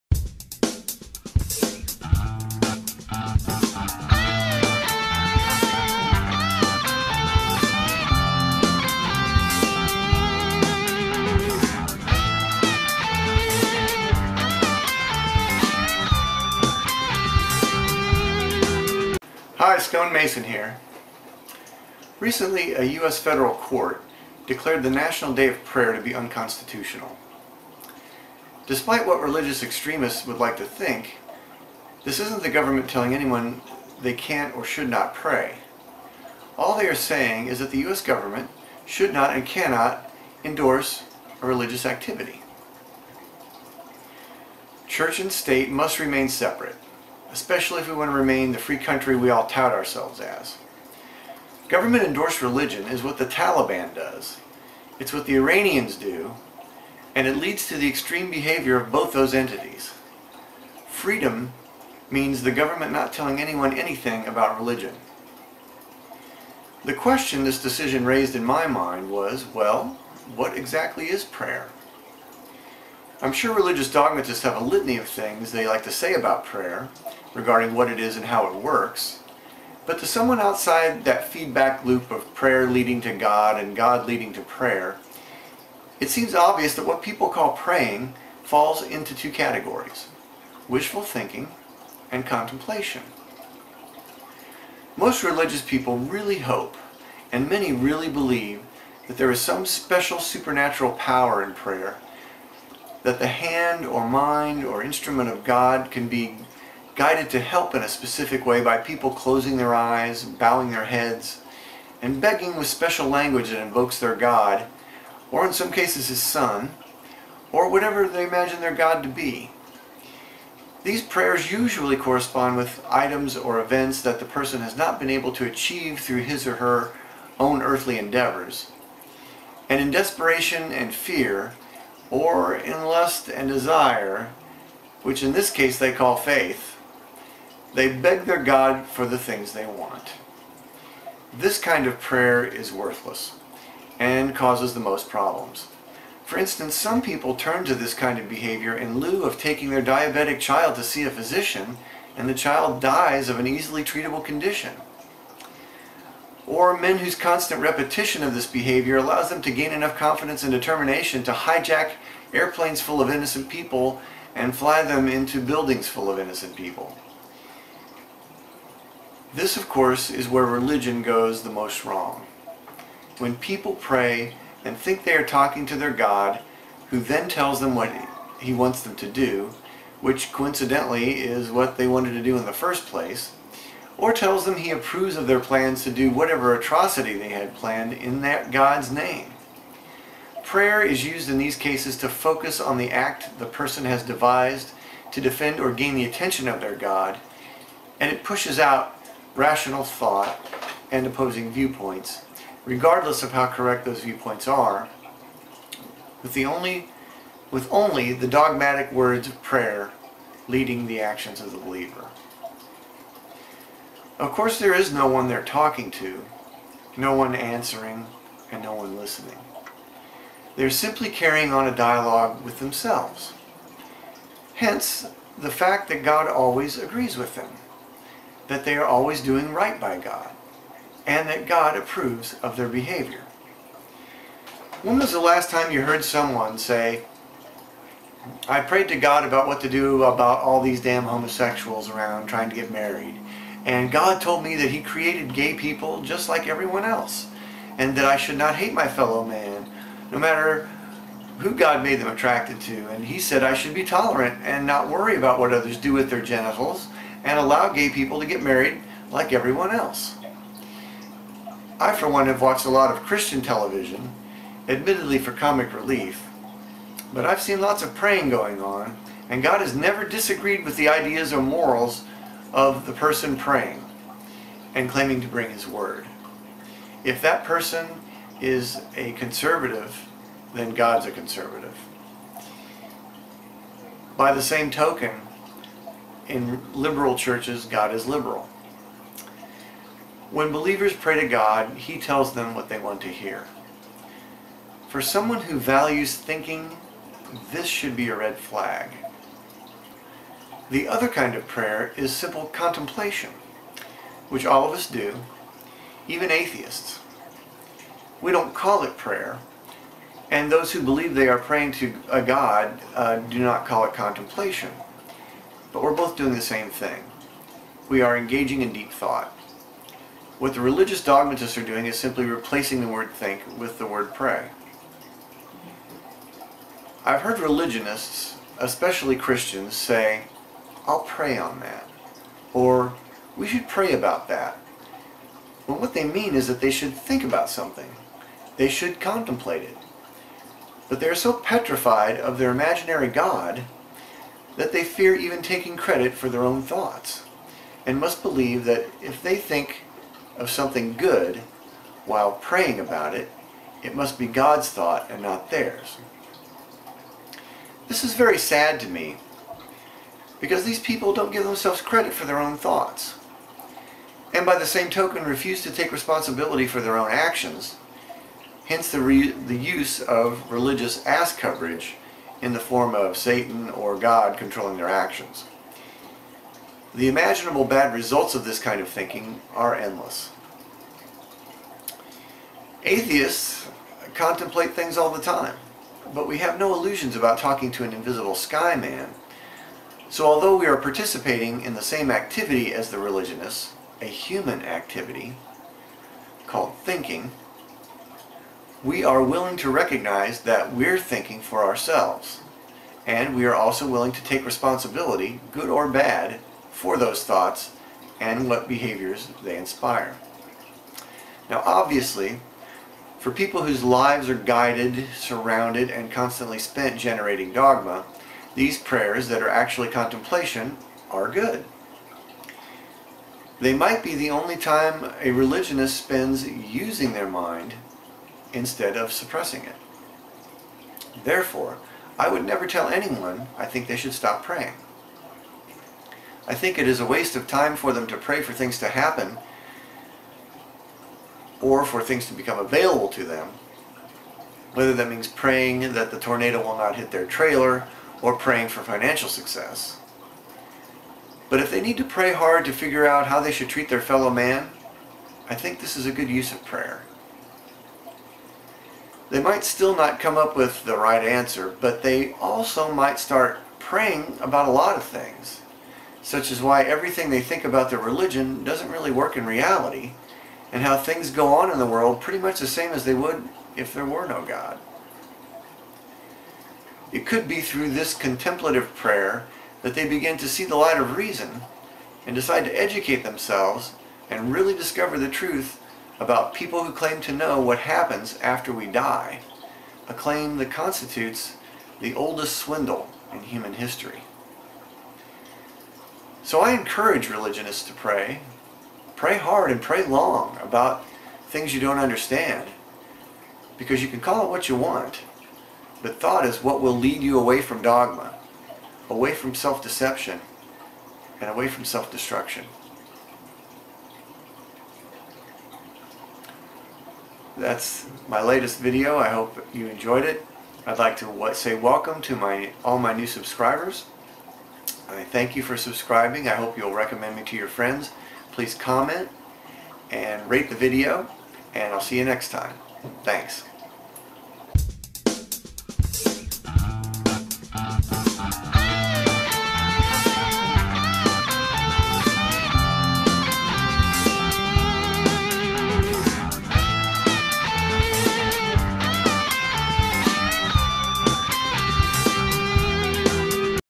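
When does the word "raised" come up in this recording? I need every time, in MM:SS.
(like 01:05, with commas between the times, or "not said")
01:08.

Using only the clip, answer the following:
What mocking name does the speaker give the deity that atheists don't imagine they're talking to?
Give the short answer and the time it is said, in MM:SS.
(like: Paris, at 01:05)
invisible sky man, at 06:27.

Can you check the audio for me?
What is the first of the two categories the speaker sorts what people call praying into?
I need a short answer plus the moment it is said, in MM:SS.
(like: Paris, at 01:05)
wishful thinking, at 01:30.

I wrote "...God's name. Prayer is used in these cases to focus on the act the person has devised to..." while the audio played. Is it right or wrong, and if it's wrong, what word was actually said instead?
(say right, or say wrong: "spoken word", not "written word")
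right.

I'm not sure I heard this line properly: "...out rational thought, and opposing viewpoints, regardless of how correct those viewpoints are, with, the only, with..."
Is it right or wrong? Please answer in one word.
right.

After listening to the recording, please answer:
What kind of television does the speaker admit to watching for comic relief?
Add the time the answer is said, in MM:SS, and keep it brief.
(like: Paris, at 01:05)
Christian television, at 04:23.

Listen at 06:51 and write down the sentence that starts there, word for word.
Now obviously, for people whose lives are guided, surrounded, and constantly spent generating dogma, these prayers that are actually contemplation are good.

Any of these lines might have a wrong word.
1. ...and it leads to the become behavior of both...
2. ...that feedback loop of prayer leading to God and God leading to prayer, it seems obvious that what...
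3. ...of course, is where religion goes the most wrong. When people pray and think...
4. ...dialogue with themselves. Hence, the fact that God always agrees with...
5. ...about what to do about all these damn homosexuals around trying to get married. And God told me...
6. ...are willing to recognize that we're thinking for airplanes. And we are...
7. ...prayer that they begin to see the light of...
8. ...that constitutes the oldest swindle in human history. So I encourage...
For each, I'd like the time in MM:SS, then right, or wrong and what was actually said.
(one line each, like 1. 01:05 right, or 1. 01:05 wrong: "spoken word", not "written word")
1. 00:57 wrong: "extreme", not "become"
2. 01:21 right
3. 02:49 right
4. 03:41 right
5. 03:59 right
6. 06:39 wrong: "ourselves", not "airplanes"
7. 07:58 right
8. 08:10 right.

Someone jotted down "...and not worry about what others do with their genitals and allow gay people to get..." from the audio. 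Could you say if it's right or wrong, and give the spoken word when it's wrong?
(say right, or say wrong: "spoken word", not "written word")
right.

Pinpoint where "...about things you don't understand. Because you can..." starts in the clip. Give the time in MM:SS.
08:20.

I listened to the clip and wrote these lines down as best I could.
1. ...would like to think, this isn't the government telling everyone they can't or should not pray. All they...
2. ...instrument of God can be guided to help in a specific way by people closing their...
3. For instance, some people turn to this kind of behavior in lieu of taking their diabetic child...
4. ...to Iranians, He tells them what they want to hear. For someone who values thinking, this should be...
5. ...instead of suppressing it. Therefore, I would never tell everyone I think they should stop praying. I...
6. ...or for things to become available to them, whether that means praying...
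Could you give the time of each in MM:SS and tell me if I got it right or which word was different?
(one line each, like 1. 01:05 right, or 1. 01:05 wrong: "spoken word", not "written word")
1. 00:30 wrong: "anyone", not "everyone"
2. 01:44 right
3. 02:26 right
4. 04:51 wrong: "God", not "Iranians"
5. 07:08 wrong: "anyone", not "everyone"
6. 07:21 right.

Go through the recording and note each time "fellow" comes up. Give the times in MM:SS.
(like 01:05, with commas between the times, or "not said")
04:08, 07:34.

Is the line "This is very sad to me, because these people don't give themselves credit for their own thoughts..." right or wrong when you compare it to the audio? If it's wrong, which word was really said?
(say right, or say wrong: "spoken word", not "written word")
right.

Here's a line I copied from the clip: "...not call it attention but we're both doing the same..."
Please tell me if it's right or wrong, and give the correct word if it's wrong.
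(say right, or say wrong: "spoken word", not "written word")
wrong: "contemplation", not "attention".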